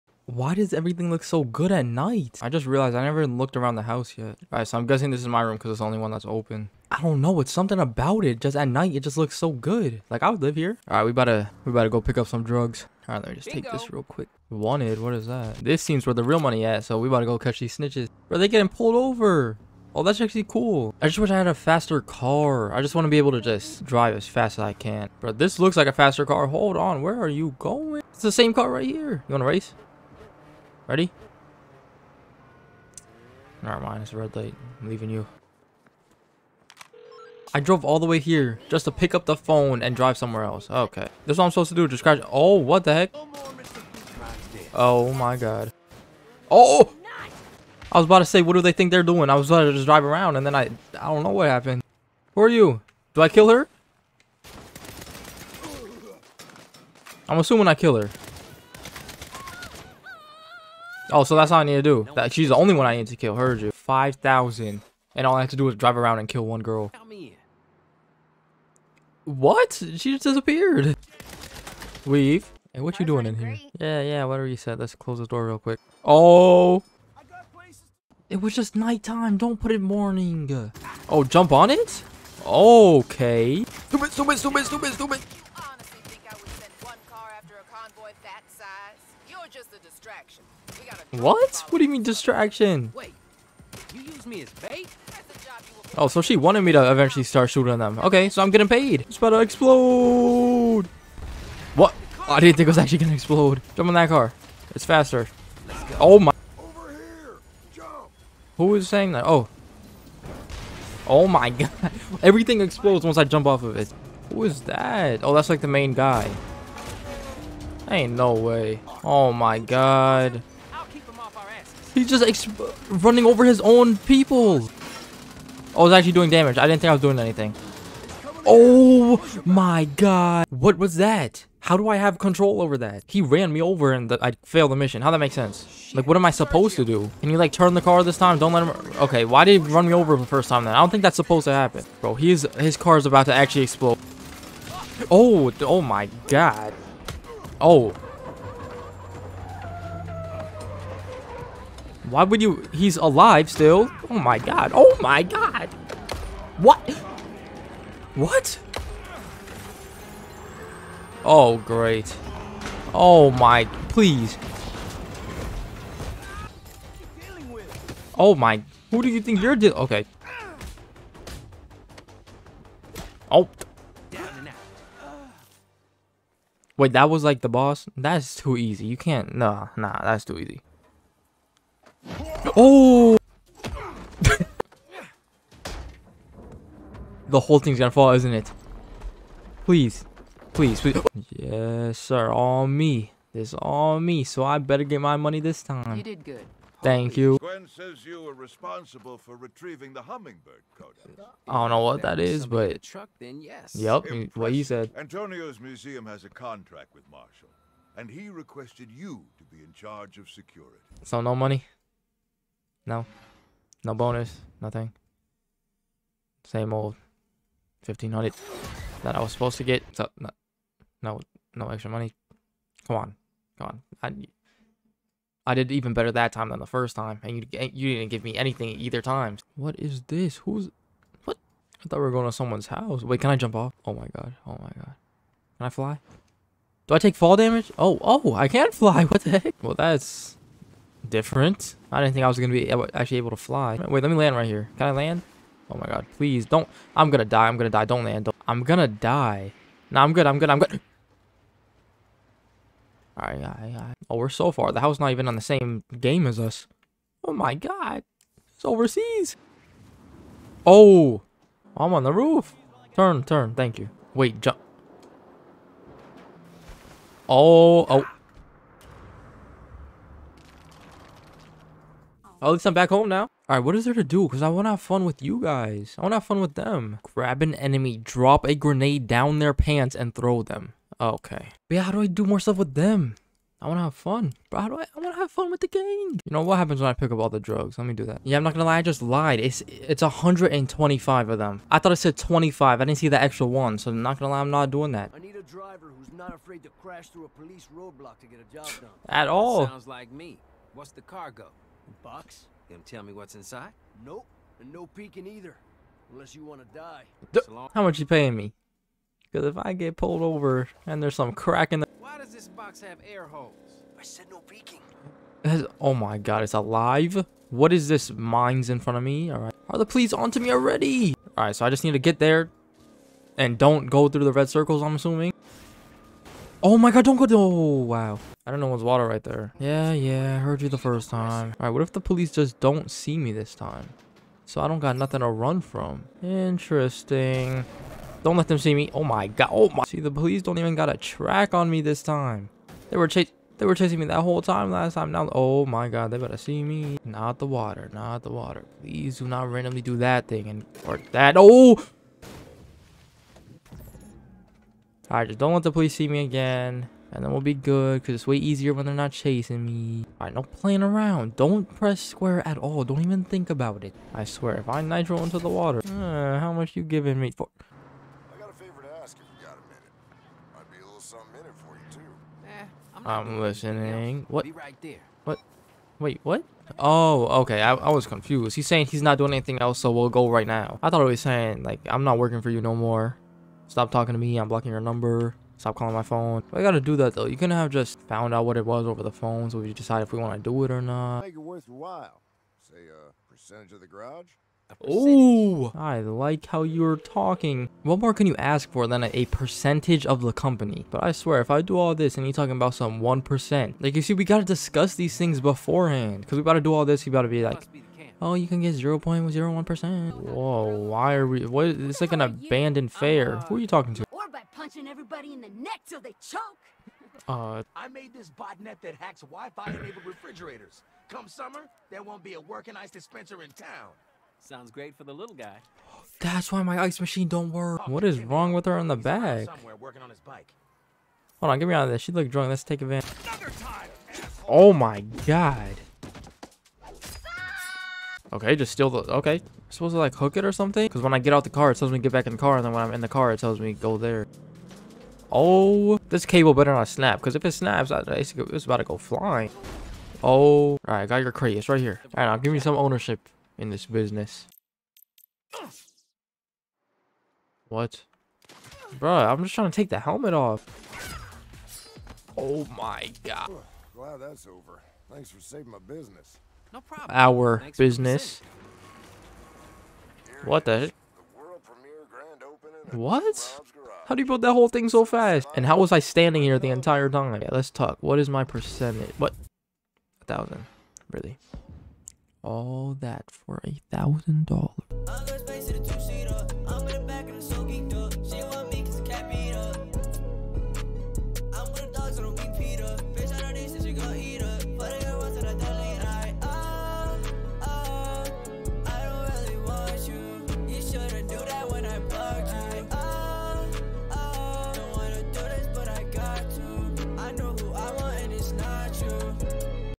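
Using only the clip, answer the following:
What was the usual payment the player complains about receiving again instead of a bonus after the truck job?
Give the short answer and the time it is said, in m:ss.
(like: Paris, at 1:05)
1500, at 3:37.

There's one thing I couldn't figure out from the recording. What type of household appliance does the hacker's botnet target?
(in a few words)
Wi-Fi enabled refrigerators.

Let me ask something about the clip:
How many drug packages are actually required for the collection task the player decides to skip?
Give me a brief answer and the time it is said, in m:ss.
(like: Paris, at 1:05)
125, at 4:50.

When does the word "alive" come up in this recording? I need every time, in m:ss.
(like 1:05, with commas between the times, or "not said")
2:32, 5:16.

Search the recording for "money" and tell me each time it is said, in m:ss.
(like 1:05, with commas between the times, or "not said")
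0:16, 3:15, 3:31, 3:41.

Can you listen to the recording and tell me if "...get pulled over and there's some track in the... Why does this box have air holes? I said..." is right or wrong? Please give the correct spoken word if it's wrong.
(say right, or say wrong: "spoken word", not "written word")
wrong: "crack", not "track".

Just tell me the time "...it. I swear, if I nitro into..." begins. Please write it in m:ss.
6:03.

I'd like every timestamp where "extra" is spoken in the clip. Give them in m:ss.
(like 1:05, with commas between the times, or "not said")
3:41, 4:53.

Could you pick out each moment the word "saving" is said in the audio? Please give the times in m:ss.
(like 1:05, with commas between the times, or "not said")
7:45.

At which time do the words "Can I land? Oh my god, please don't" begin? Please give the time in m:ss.
4:04.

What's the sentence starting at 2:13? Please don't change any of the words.
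He ran me over and the, I failed the mission.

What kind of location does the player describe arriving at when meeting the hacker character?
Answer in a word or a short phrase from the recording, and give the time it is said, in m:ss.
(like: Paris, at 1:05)
an abandoned fair, at 6:52.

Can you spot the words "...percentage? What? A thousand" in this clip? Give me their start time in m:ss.
7:58.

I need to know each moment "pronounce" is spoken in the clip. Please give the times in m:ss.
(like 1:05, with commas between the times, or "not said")
not said.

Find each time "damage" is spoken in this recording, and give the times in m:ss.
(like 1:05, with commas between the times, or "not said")
2:06, 3:57.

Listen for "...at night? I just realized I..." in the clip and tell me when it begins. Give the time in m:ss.
0:01.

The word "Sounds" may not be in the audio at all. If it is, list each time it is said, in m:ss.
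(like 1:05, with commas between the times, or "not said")
4:59, 7:04.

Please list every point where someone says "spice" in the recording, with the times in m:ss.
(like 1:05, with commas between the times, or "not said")
not said.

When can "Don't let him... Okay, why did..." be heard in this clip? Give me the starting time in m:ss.
2:18.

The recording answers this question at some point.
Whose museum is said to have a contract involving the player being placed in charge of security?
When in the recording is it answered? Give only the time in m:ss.
3:24.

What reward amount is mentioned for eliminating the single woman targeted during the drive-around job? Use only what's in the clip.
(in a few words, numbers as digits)
5,000.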